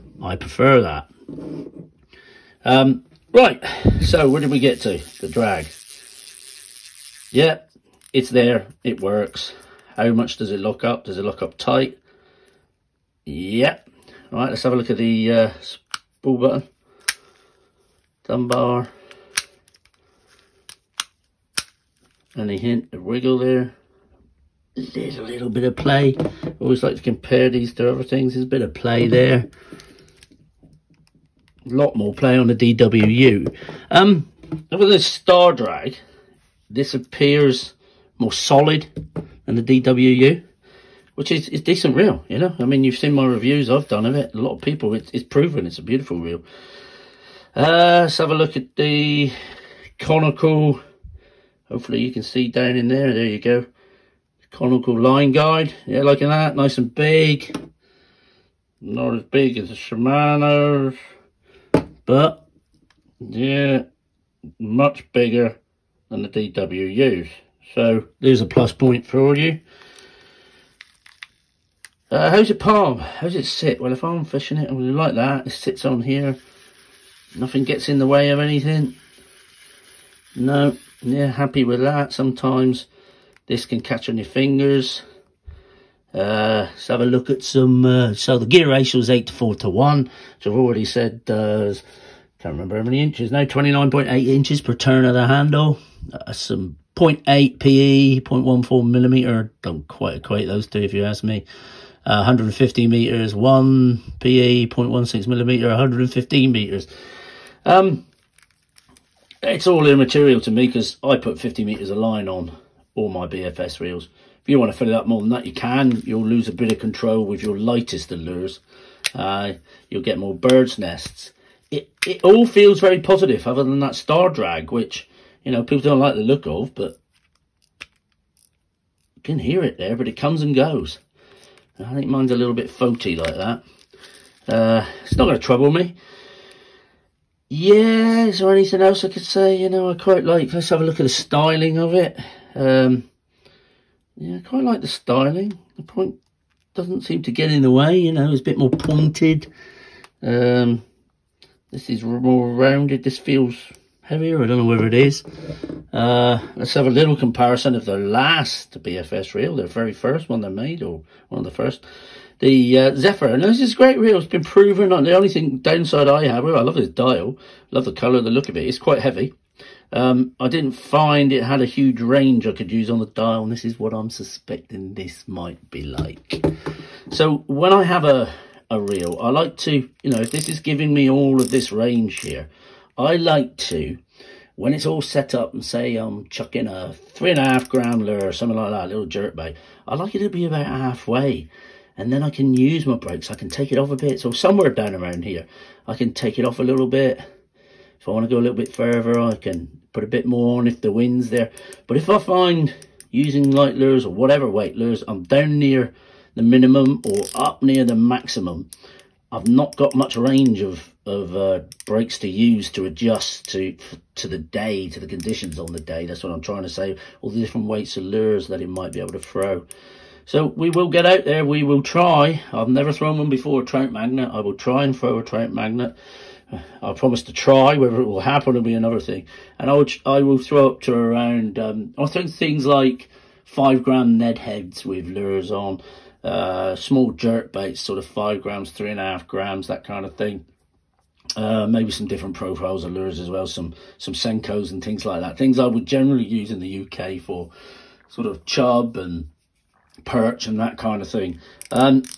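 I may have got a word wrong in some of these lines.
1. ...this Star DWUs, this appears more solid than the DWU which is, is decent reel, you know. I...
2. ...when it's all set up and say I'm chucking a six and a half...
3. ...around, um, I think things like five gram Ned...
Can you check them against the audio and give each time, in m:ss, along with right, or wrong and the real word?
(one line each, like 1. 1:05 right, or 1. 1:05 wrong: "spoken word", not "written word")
1. 0:34 wrong: "Drag", not "DWUs"
2. 3:04 wrong: "three", not "six"
3. 3:50 right.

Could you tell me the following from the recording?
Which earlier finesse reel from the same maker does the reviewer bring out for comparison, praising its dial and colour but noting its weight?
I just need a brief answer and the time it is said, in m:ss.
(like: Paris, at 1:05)
Zephyr, at 2:42.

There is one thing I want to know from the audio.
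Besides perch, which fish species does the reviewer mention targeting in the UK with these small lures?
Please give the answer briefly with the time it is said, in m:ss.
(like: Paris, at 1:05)
chub, at 4:08.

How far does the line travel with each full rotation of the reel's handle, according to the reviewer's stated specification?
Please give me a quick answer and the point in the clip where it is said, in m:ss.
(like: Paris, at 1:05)
29.8 inches, at 1:33.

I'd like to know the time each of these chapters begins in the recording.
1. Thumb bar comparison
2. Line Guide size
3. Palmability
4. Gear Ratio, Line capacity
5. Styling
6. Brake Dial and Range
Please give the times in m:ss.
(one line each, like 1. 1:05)
1. 0:15
2. 0:50
3. 1:14
4. 1:28
5. 2:21
6. 2:59.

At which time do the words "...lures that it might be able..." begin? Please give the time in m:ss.
3:38.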